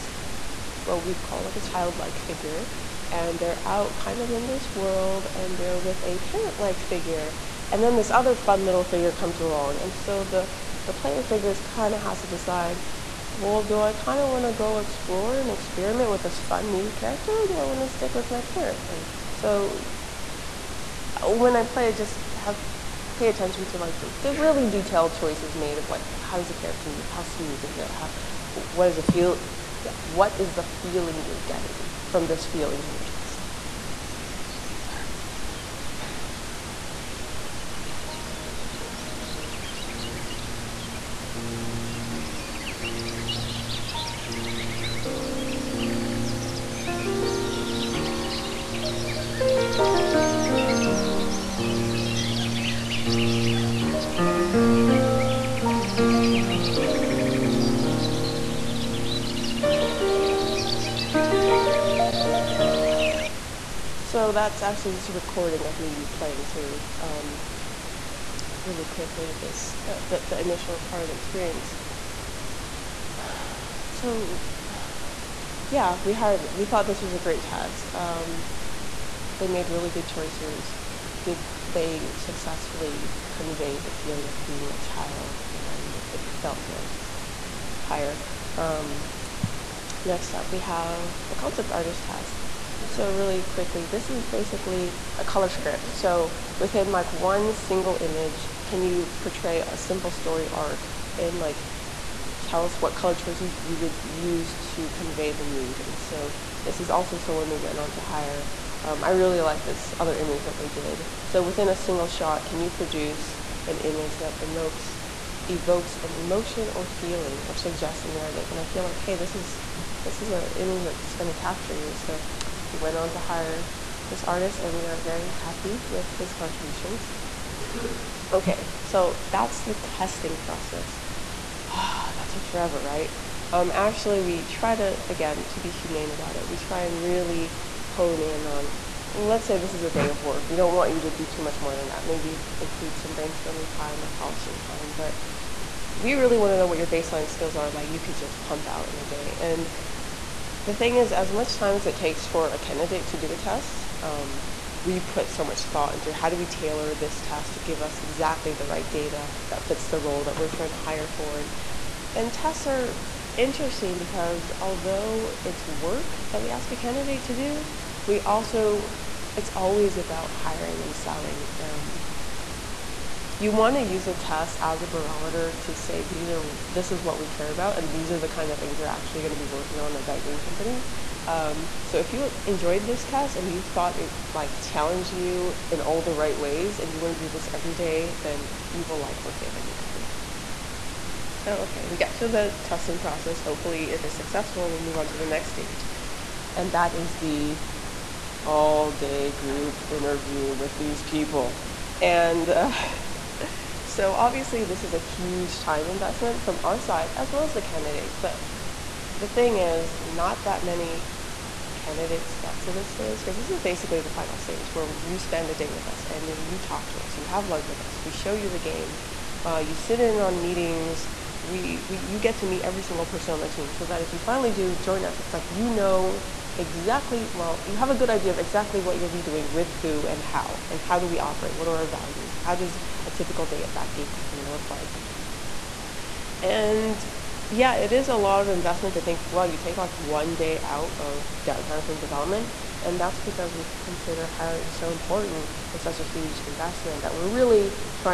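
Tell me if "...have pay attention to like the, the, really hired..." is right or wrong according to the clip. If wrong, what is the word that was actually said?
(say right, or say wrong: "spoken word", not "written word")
wrong: "detailed", not "hired".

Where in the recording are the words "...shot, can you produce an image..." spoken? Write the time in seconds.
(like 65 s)
112 s.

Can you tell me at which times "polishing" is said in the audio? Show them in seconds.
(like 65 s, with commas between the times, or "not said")
144 s.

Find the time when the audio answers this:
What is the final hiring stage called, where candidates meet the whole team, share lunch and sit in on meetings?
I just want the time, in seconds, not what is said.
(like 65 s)
198 s.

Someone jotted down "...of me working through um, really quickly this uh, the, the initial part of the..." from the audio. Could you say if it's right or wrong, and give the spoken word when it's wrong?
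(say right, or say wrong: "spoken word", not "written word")
wrong: "playing", not "working".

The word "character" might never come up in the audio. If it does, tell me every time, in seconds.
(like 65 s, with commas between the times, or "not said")
16 s, 26 s.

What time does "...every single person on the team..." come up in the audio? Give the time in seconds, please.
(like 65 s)
222 s.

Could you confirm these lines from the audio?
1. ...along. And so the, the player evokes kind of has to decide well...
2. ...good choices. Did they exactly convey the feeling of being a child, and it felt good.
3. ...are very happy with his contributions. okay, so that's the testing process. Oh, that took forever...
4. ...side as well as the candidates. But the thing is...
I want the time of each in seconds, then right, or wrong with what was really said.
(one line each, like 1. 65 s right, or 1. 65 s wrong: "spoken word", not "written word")
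1. 9 s wrong: "figures", not "evokes"
2. 79 s wrong: "successfully", not "exactly"
3. 124 s right
4. 206 s right.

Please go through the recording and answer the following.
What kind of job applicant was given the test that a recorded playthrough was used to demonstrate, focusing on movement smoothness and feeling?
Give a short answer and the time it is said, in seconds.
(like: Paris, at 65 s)
feel engineer, at 32 s.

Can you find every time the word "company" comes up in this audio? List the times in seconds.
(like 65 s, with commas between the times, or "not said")
180 s, 189 s, 234 s.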